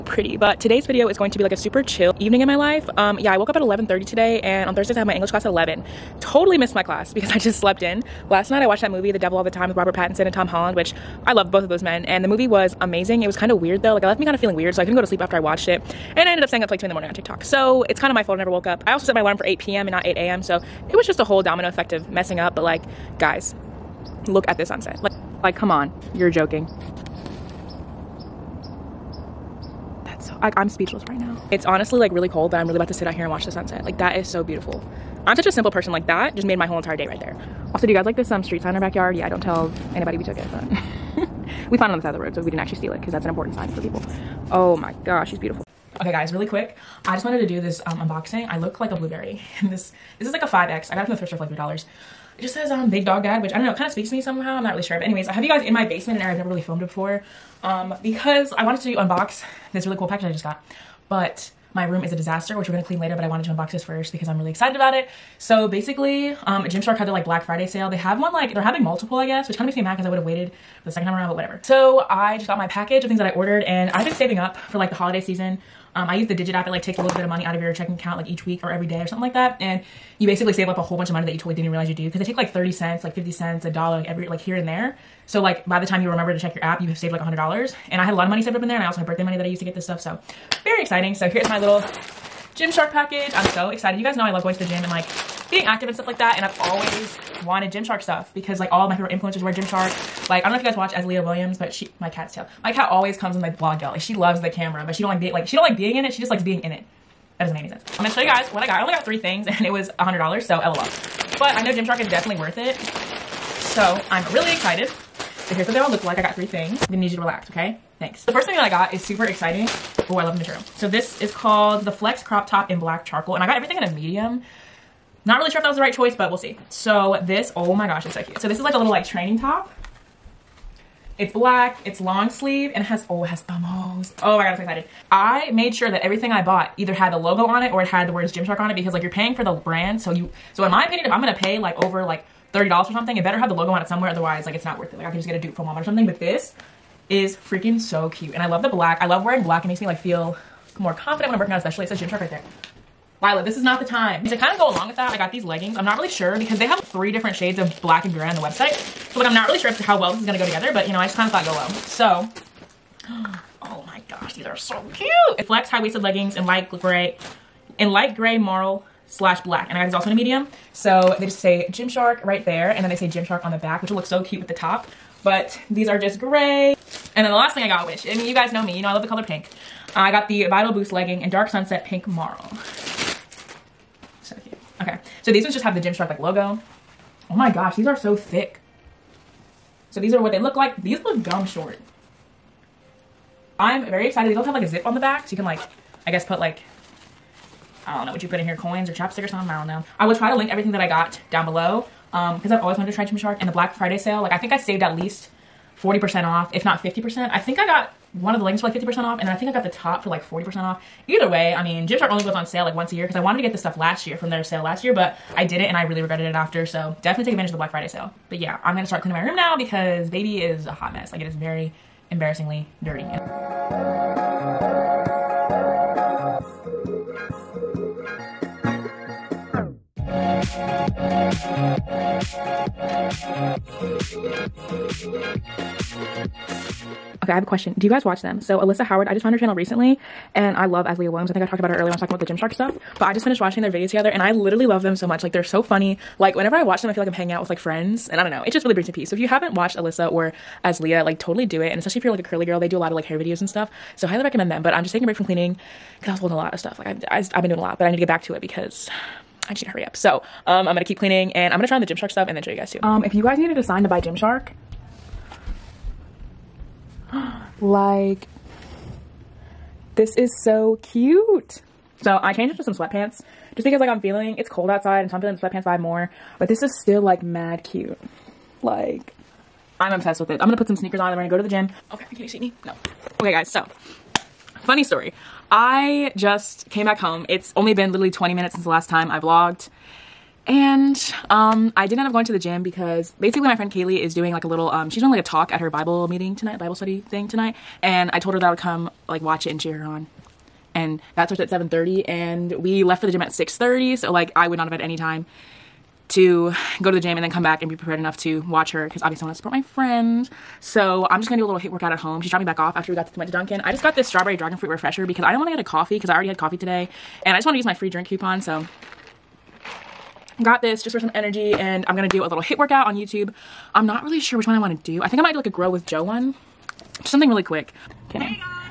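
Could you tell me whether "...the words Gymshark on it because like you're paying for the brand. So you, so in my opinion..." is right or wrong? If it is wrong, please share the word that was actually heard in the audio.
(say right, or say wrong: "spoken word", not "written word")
right.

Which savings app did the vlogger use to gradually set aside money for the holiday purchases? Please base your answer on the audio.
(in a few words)
Digit.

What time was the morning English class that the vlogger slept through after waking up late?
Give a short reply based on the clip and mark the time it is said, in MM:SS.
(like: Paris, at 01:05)
11, at 00:05.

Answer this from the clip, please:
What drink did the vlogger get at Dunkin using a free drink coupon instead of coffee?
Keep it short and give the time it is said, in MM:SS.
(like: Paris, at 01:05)
strawberry dragon fruit refresher, at 05:14.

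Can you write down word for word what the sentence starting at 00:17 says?
So it's kind of my fault I never woke up.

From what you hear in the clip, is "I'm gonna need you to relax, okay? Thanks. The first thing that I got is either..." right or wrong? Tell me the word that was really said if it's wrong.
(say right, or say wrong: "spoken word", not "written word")
wrong: "super", not "either".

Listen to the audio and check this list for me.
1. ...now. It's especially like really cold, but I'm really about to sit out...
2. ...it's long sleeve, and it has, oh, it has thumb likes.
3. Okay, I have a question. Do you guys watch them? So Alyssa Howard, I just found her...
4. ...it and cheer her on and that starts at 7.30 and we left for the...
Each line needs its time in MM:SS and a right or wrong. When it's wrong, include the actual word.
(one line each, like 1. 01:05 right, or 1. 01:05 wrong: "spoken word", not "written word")
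1. 00:31 wrong: "honestly", not "especially"
2. 02:11 wrong: "holes", not "likes"
3. 03:57 right
4. 04:59 right.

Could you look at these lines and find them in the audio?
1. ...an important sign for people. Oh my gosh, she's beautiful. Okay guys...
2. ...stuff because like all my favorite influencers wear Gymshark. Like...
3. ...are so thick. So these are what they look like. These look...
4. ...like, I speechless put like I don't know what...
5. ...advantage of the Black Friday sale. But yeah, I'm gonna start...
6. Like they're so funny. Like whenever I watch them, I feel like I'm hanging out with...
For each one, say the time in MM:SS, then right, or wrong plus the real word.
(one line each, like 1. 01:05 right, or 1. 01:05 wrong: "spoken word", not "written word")
1. 00:43 right
2. 01:37 right
3. 03:07 right
4. 03:15 wrong: "guess", not "speechless"
5. 03:37 right
6. 04:05 right.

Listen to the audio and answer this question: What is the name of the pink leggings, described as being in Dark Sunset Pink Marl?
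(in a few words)
Vital Boost.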